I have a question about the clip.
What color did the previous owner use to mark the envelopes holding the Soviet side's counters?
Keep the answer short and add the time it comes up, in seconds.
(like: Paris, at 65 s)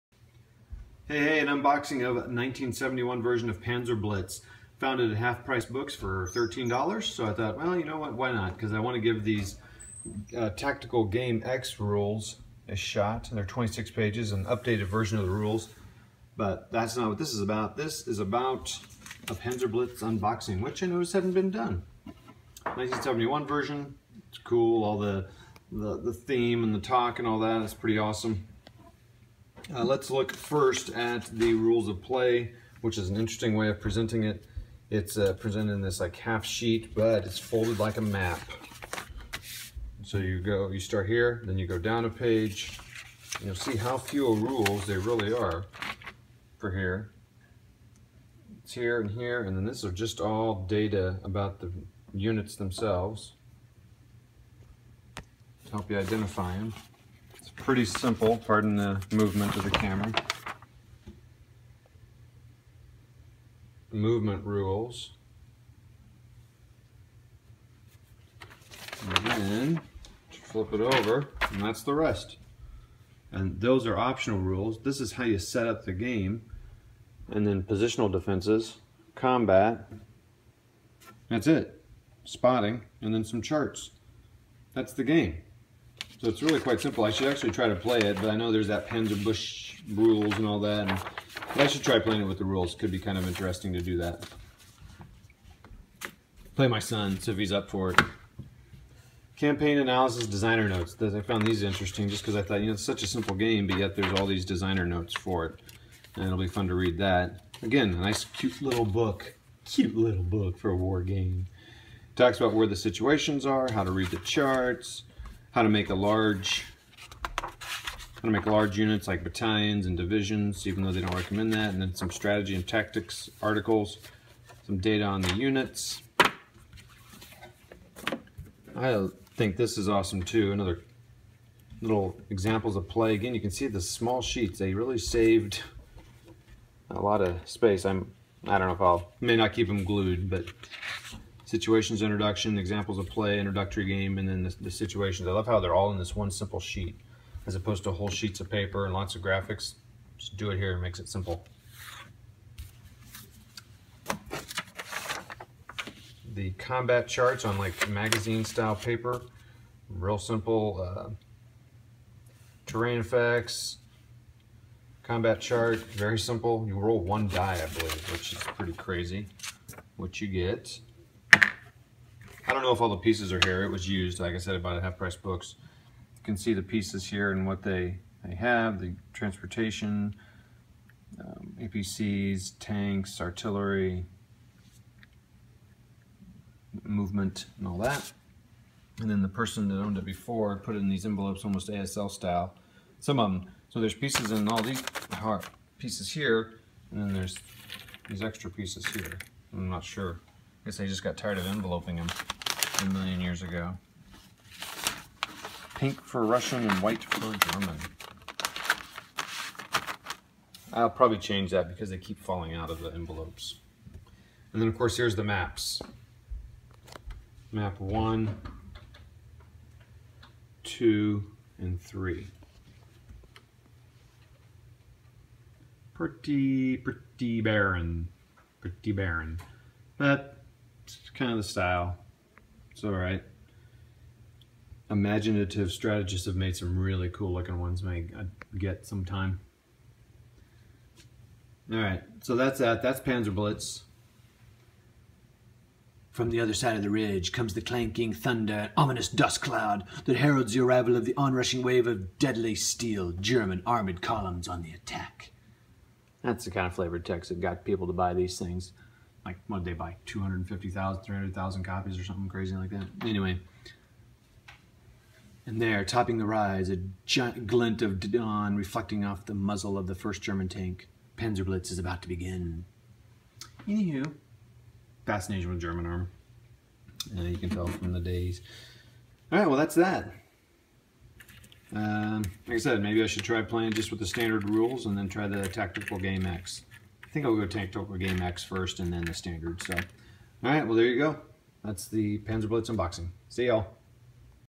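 Pink, at 205 s.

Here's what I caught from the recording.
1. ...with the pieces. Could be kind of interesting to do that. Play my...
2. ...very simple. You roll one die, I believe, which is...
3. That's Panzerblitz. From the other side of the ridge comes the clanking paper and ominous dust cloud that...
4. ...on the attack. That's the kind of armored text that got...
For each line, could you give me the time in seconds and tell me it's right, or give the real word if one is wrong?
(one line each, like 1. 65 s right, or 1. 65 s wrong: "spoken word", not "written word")
1. 92 s wrong: "rules", not "pieces"
2. 165 s right
3. 242 s wrong: "thunder", not "paper"
4. 254 s wrong: "flavored", not "armored".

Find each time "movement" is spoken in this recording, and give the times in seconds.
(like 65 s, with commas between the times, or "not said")
59 s, 63 s, 186 s.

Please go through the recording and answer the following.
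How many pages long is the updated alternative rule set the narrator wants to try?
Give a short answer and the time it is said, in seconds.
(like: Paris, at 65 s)
26, at 13 s.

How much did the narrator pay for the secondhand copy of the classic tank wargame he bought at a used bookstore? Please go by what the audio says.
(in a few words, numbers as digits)
$13.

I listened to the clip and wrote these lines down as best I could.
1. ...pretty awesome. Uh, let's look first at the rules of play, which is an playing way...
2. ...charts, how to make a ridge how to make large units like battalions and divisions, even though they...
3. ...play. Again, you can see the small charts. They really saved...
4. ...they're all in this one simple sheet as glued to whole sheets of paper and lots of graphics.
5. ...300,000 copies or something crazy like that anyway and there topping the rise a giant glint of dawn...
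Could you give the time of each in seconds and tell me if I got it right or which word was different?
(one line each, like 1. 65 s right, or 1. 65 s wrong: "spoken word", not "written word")
1. 27 s wrong: "interesting", not "playing"
2. 114 s wrong: "large", not "ridge"
3. 132 s wrong: "sheets", not "charts"
4. 145 s wrong: "opposed", not "glued"
5. 261 s right.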